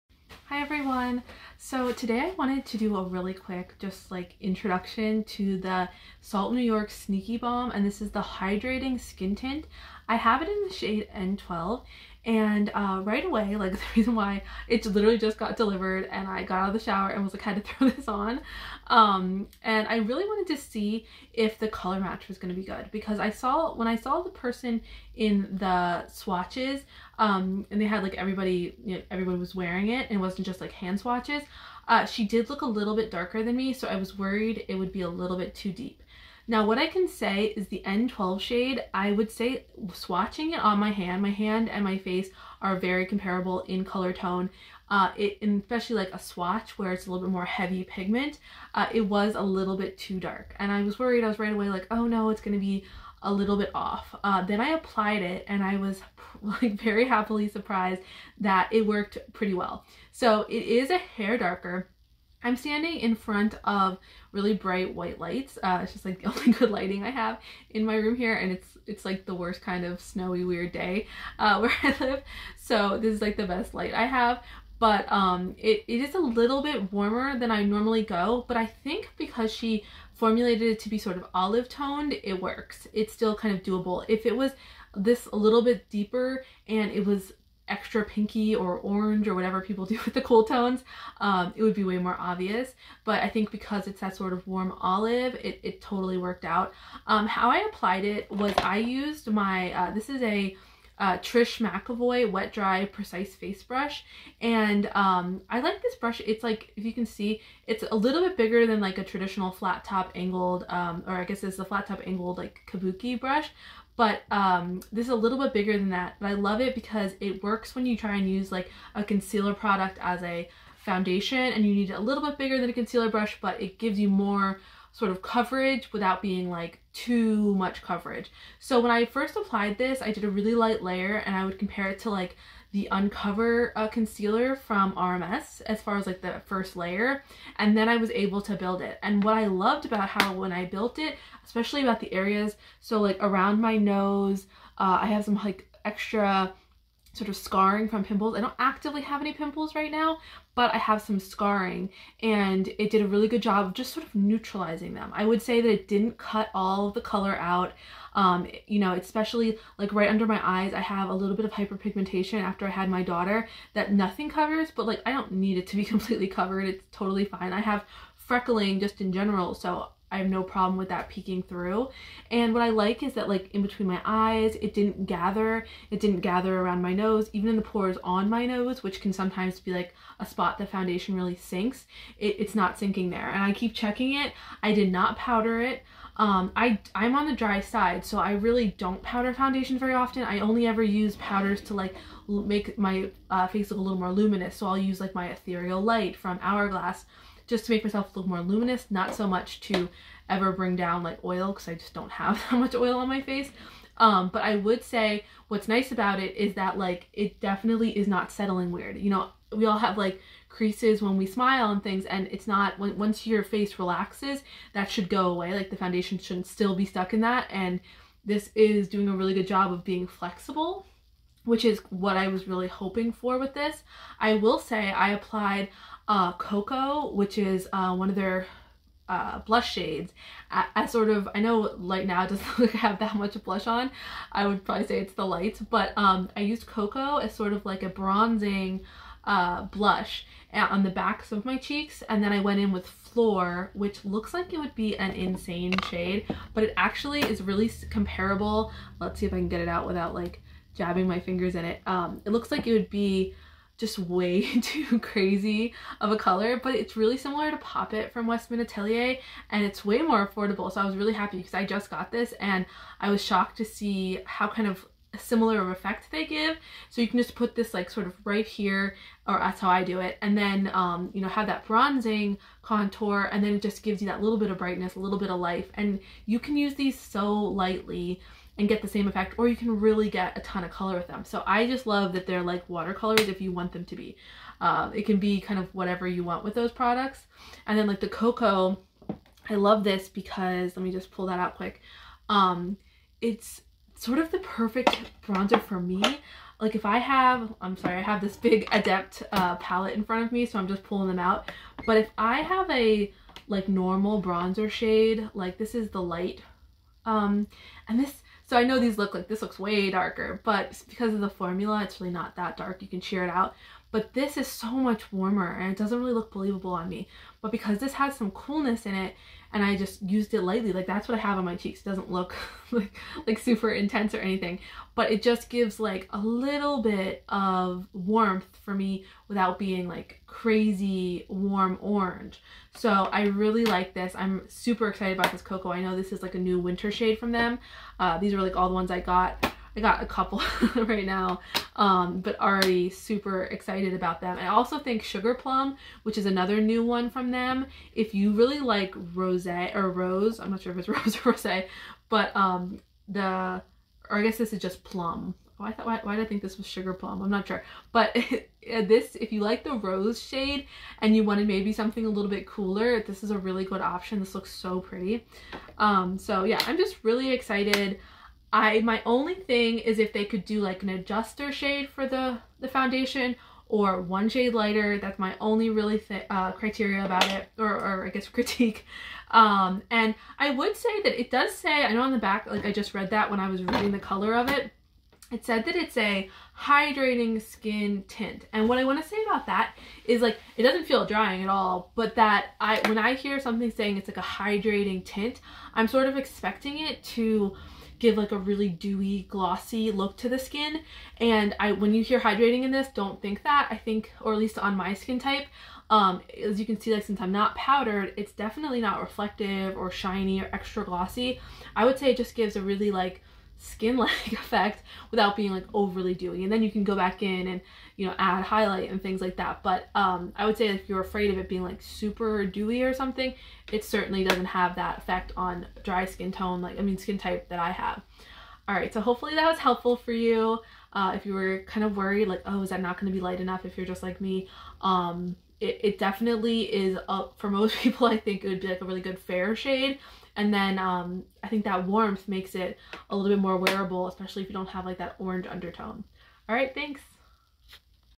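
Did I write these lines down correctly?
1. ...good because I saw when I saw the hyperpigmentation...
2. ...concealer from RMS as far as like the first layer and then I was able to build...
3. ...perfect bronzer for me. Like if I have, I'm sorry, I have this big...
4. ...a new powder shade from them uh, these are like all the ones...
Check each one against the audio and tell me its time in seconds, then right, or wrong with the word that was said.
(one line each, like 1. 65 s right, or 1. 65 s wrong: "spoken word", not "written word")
1. 22 s wrong: "person", not "hyperpigmentation"
2. 133 s right
3. 294 s right
4. 336 s wrong: "winter", not "powder".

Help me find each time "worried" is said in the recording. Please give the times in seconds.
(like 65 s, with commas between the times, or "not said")
34 s, 50 s, 431 s.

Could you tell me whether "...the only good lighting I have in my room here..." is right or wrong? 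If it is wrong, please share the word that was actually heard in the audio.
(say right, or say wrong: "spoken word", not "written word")
right.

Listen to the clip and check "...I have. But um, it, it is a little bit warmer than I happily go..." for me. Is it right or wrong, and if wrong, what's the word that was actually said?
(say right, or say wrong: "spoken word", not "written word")
wrong: "normally", not "happily".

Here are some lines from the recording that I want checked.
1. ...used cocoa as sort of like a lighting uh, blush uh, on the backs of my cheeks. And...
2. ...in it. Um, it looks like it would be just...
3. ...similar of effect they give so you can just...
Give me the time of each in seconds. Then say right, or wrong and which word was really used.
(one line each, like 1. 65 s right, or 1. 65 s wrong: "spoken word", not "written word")
1. 236 s wrong: "bronzing", not "lighting"
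2. 251 s right
3. 265 s right.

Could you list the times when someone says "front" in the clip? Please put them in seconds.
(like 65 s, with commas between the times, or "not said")
63 s, 300 s.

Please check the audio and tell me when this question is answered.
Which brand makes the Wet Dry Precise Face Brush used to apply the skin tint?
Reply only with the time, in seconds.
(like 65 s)
101 s.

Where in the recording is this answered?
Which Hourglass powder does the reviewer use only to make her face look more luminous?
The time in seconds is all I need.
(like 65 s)
195 s.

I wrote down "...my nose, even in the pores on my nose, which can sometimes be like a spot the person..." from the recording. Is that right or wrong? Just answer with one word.
wrong.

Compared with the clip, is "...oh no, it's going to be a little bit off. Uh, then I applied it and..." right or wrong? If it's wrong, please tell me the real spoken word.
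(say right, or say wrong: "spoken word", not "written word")
right.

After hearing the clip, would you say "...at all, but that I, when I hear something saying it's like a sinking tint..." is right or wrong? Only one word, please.
wrong.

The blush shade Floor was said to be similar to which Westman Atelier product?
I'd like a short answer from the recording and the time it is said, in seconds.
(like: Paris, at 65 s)
Pop It, at 257 s.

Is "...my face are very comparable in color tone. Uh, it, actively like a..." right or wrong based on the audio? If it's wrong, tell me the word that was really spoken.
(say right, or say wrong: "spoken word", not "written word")
wrong: "especially", not "actively".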